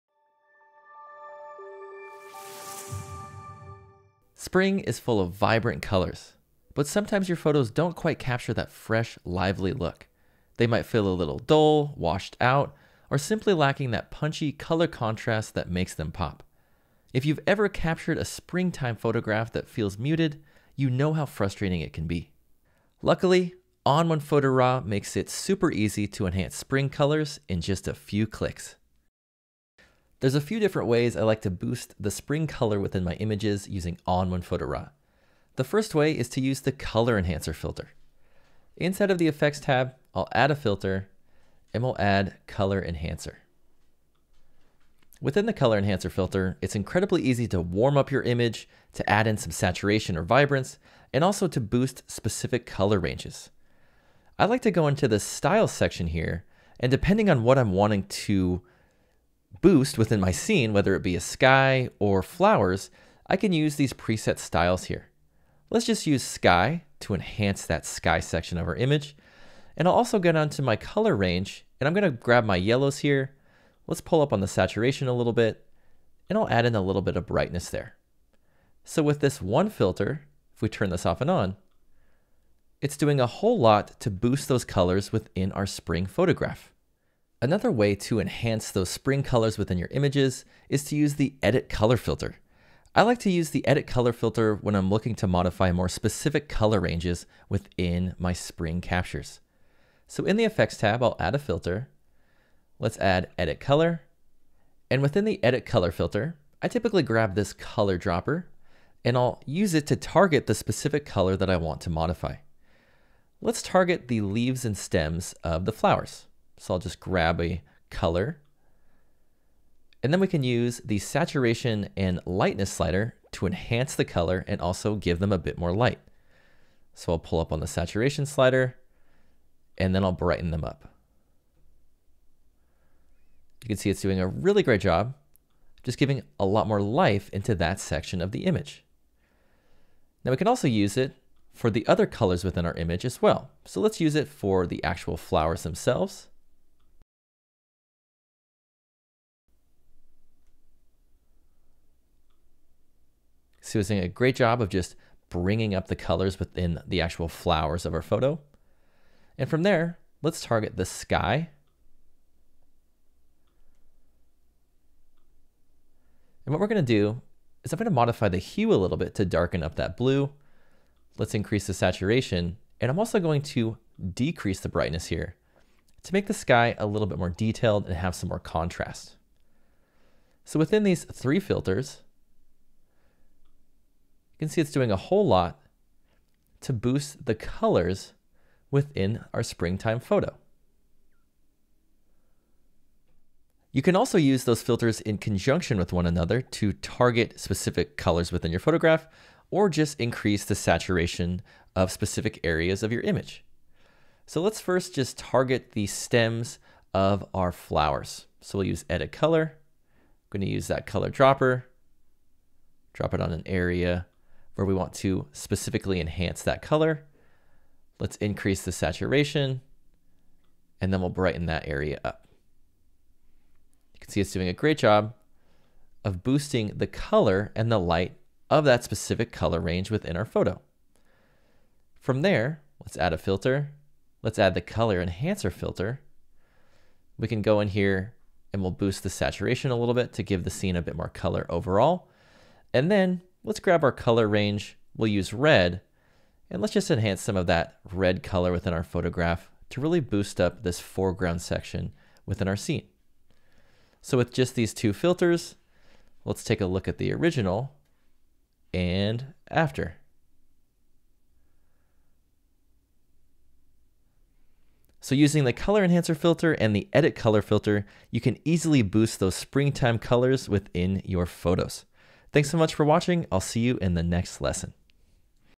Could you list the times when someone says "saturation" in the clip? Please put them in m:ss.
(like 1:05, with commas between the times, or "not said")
0:49, 1:14, 2:00, 2:07, 2:51, 3:20, 3:38, 3:59.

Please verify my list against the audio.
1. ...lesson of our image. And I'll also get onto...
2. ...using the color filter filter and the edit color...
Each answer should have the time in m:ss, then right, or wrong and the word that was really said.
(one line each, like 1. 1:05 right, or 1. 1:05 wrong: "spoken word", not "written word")
1. 1:08 wrong: "section", not "lesson"
2. 4:25 wrong: "enhancer", not "filter".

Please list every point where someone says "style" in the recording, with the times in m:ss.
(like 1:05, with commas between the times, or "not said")
0:55, 1:04.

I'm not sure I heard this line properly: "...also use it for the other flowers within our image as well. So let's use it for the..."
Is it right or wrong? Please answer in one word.
wrong.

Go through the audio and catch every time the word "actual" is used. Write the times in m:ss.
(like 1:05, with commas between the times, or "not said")
2:24, 2:37.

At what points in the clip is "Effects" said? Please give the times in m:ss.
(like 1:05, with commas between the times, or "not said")
0:39, 1:40.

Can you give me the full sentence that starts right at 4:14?
So with just these two filters, let's take a look at the original and after.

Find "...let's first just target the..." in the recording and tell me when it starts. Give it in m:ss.
3:24.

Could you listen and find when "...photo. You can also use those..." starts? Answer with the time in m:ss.
3:09.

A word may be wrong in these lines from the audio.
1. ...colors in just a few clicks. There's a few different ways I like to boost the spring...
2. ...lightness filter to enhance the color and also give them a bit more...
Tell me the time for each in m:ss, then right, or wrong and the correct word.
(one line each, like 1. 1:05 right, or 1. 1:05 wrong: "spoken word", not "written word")
1. 0:26 right
2. 2:02 wrong: "slider", not "filter".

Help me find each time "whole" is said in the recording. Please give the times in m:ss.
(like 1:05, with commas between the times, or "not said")
1:23, 3:04.